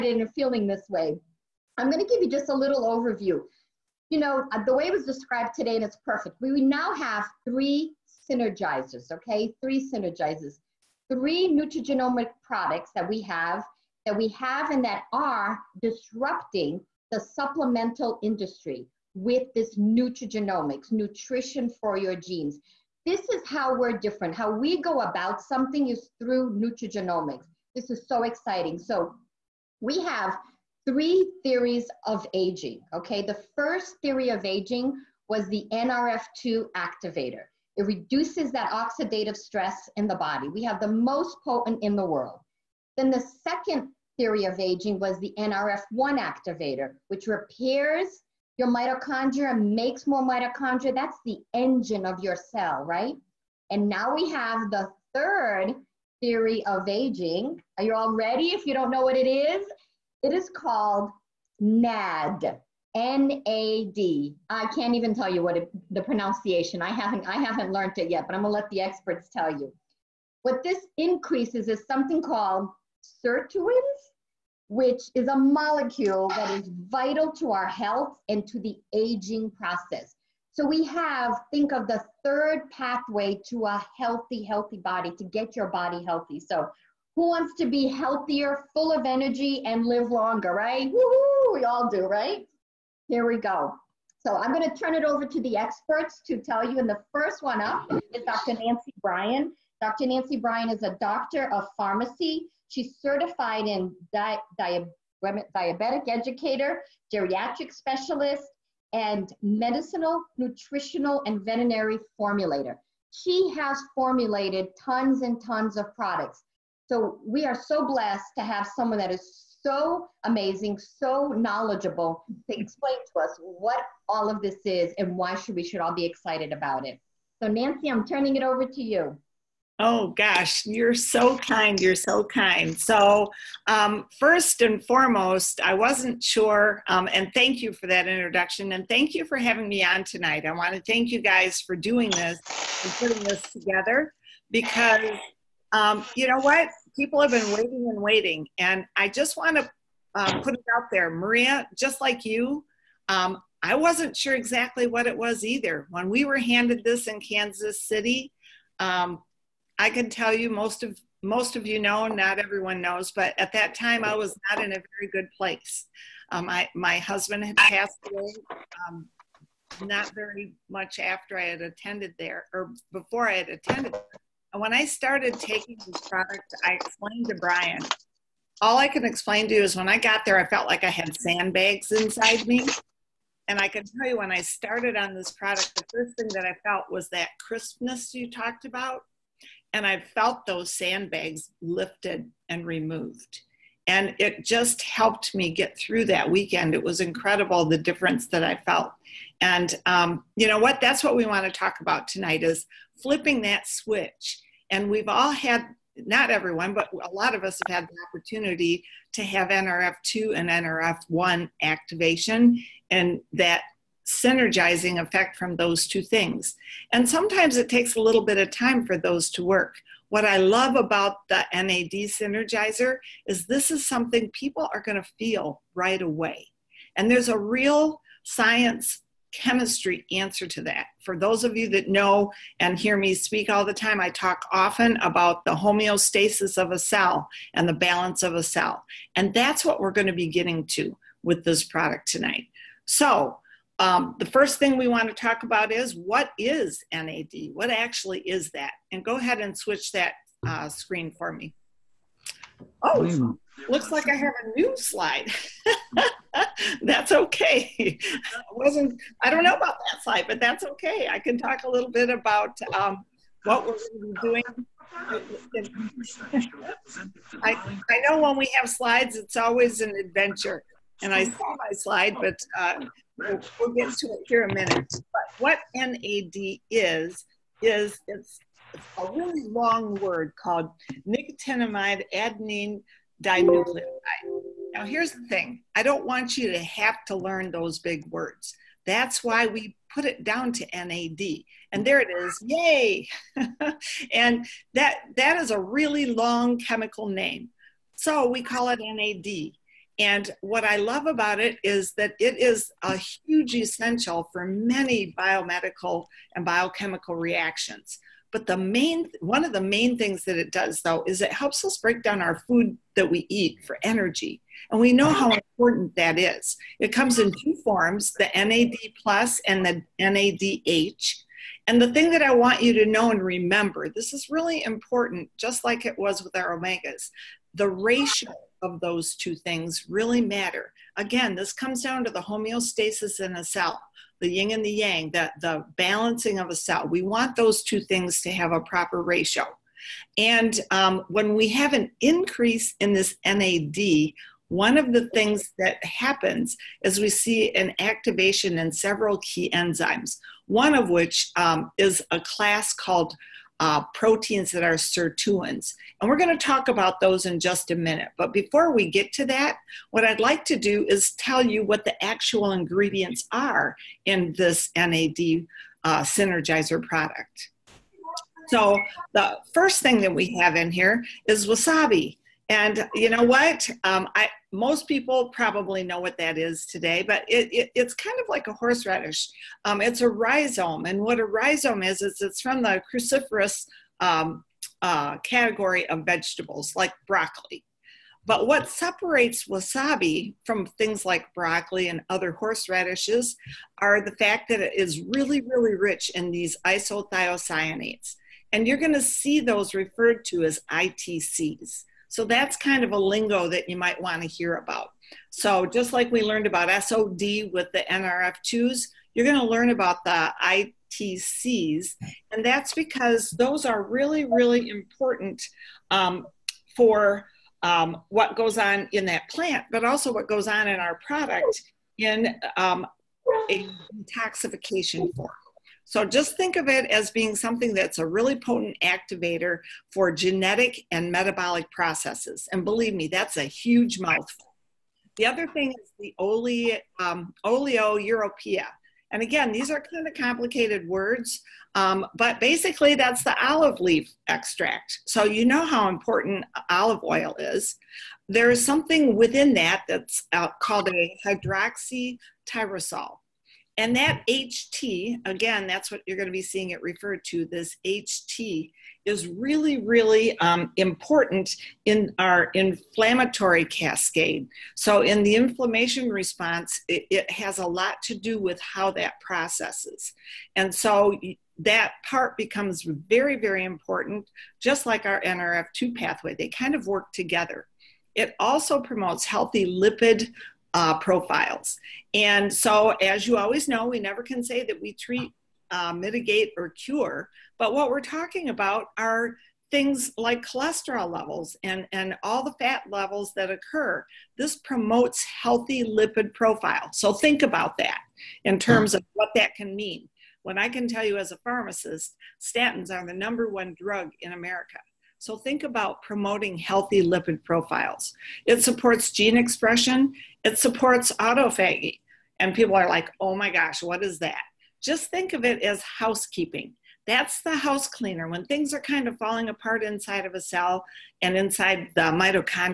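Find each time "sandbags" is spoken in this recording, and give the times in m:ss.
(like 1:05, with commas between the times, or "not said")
3:01, 3:10.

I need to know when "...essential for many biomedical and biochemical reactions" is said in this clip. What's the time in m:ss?
5:03.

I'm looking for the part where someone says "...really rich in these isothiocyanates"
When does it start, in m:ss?
6:35.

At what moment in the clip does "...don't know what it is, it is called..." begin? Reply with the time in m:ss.
0:58.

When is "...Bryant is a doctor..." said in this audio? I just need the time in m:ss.
1:40.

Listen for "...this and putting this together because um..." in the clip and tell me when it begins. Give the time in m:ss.
2:22.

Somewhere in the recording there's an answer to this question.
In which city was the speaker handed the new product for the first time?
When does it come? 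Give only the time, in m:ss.
2:37.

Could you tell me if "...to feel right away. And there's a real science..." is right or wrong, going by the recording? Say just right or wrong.
right.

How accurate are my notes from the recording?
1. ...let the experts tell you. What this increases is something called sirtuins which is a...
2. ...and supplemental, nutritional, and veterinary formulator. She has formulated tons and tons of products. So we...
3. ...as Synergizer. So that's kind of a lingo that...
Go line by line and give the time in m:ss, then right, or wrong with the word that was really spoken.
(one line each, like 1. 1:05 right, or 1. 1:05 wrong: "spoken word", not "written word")
1. 1:08 right
2. 1:48 wrong: "medicinal", not "supplemental"
3. 6:40 wrong: "ITCs", not "Synergizer".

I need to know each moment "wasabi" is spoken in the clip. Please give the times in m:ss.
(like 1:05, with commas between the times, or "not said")
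6:11, 6:29.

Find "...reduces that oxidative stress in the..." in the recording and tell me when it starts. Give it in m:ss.
0:37.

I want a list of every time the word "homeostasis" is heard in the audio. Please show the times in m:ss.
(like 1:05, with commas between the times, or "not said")
3:55, 5:32.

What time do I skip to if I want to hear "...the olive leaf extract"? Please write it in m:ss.
7:23.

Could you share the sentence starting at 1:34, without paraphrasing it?
So I'm going to turn it over to the experts to tell you.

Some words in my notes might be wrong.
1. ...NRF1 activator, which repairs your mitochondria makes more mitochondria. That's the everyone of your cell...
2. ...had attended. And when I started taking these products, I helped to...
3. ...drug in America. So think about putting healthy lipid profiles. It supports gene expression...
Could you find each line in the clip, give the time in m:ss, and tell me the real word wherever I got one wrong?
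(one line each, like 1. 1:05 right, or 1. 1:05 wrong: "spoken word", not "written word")
1. 0:45 wrong: "engine", not "everyone"
2. 2:53 wrong: "explained", not "helped"
3. 8:23 wrong: "promoting", not "putting".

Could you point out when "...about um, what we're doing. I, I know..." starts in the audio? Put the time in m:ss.
4:22.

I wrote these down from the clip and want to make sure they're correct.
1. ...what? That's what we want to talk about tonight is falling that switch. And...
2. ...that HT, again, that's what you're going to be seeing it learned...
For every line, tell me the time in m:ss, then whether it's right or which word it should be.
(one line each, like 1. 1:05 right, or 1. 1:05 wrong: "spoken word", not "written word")
1. 3:20 wrong: "flipping", not "falling"
2. 7:33 wrong: "referred", not "learned".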